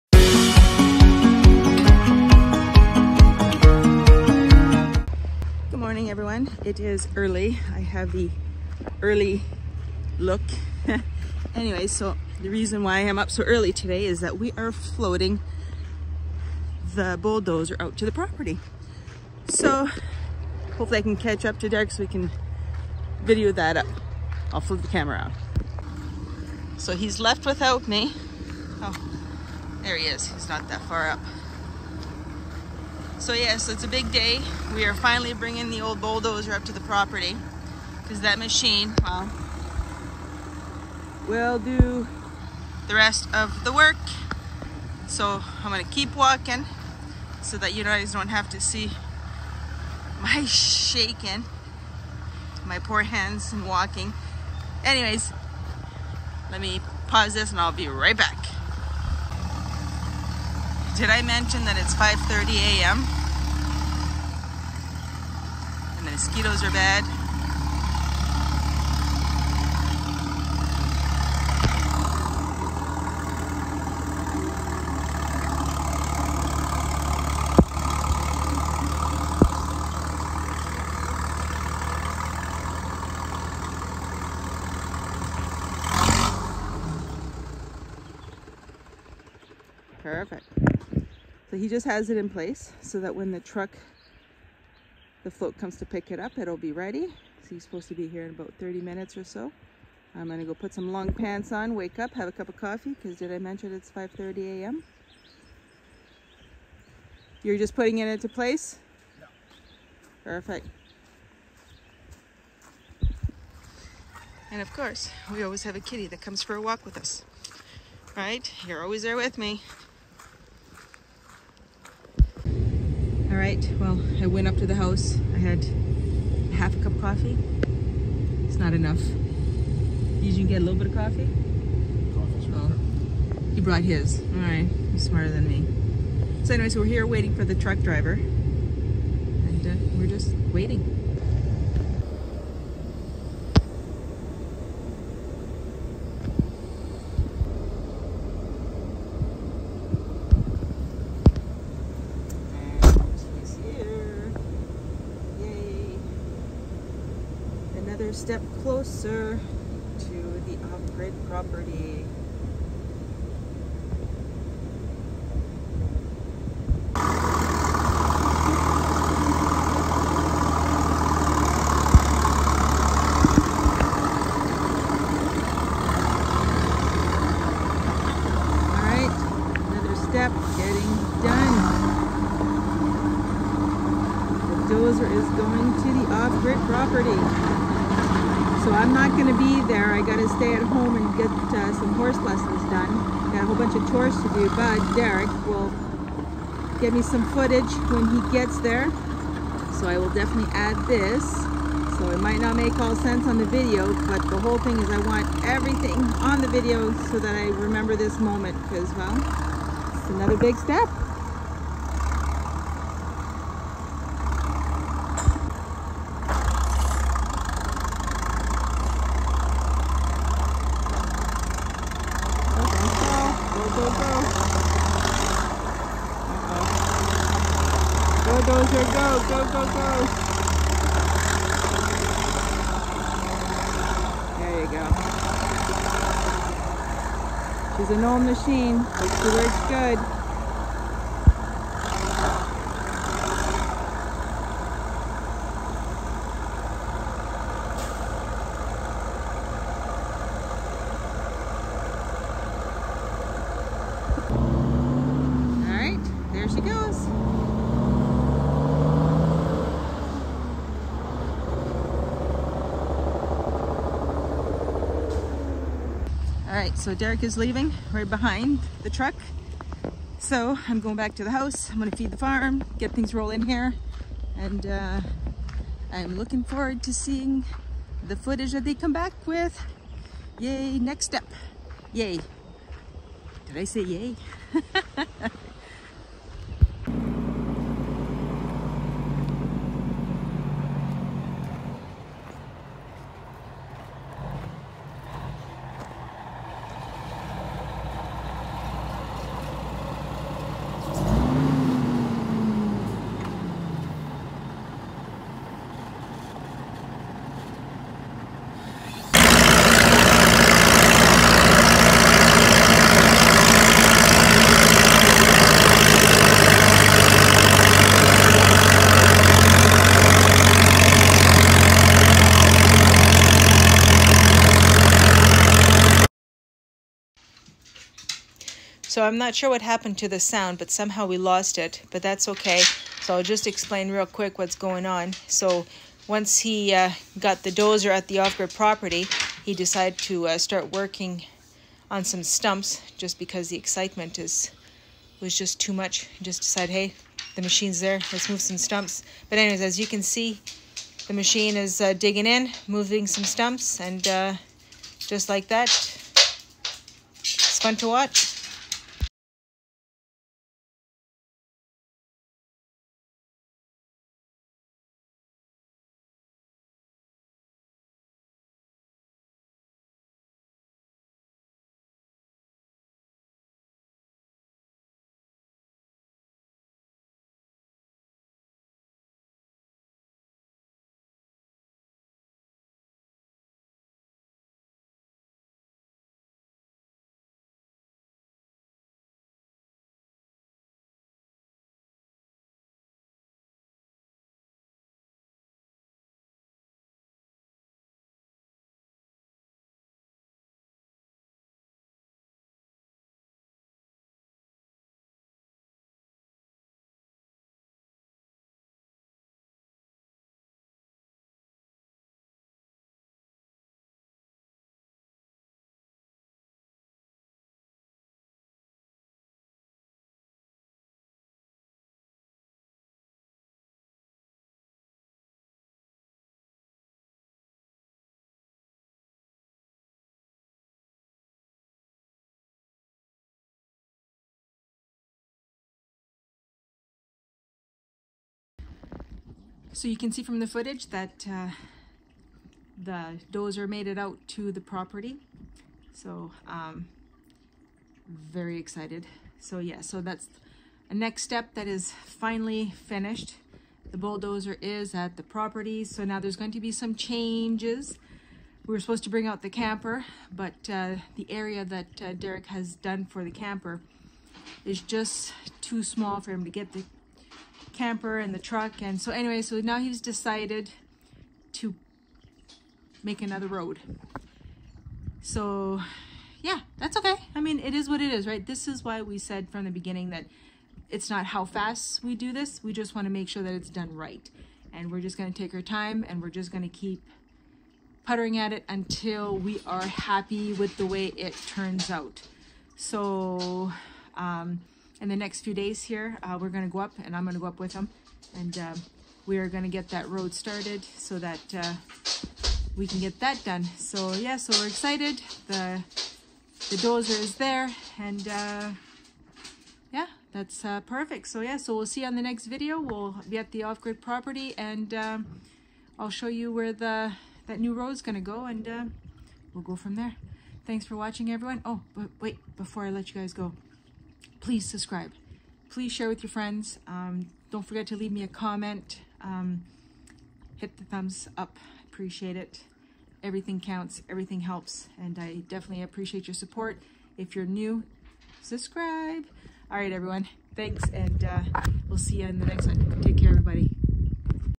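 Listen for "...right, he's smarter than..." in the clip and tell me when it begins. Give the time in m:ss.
2:14.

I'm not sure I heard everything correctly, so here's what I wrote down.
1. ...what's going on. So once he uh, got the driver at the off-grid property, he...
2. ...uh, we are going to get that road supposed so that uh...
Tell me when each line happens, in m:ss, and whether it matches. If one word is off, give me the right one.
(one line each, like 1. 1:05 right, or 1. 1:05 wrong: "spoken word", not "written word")
1. 5:34 wrong: "dozer", not "driver"
2. 8:18 wrong: "started", not "supposed".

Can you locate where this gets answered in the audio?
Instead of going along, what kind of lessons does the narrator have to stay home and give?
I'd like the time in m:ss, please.
3:11.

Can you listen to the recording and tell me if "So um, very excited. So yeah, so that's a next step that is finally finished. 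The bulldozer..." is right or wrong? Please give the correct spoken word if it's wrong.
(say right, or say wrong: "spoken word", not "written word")
right.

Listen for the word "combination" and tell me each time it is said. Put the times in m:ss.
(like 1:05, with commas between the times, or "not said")
not said.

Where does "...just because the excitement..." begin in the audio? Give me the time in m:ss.
5:42.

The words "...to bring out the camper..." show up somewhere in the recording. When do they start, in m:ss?
7:39.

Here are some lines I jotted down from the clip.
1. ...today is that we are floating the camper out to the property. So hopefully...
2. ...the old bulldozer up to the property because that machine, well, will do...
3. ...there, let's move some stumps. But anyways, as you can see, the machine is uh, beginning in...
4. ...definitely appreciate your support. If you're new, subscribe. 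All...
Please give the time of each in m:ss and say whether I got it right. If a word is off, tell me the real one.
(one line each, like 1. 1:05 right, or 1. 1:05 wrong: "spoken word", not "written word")
1. 0:13 wrong: "bulldozer", not "camper"
2. 0:35 right
3. 5:47 wrong: "digging", not "beginning"
4. 8:55 right.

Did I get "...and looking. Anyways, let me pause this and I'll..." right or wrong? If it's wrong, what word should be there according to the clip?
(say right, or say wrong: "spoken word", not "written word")
wrong: "walking", not "looking".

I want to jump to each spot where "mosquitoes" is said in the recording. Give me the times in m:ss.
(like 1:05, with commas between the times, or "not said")
1:06.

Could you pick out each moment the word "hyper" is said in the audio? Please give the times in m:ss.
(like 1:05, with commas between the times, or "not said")
not said.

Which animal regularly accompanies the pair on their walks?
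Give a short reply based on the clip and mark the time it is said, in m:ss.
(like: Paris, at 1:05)
Kitty, at 1:55.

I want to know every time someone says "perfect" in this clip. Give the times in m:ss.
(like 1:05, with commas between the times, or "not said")
1:30, 1:50, 8:30.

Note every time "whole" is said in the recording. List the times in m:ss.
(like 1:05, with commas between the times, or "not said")
3:13, 3:24.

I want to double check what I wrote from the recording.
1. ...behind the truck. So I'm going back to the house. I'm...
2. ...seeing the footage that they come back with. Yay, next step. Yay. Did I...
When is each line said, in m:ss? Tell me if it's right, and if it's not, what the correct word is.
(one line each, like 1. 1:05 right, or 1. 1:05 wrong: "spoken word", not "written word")
1. 4:28 right
2. 4:36 right.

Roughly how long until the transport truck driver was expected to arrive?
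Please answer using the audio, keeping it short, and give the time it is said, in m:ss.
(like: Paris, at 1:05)
30 minutes, at 1:38.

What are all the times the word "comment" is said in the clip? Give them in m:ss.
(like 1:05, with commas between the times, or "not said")
8:48.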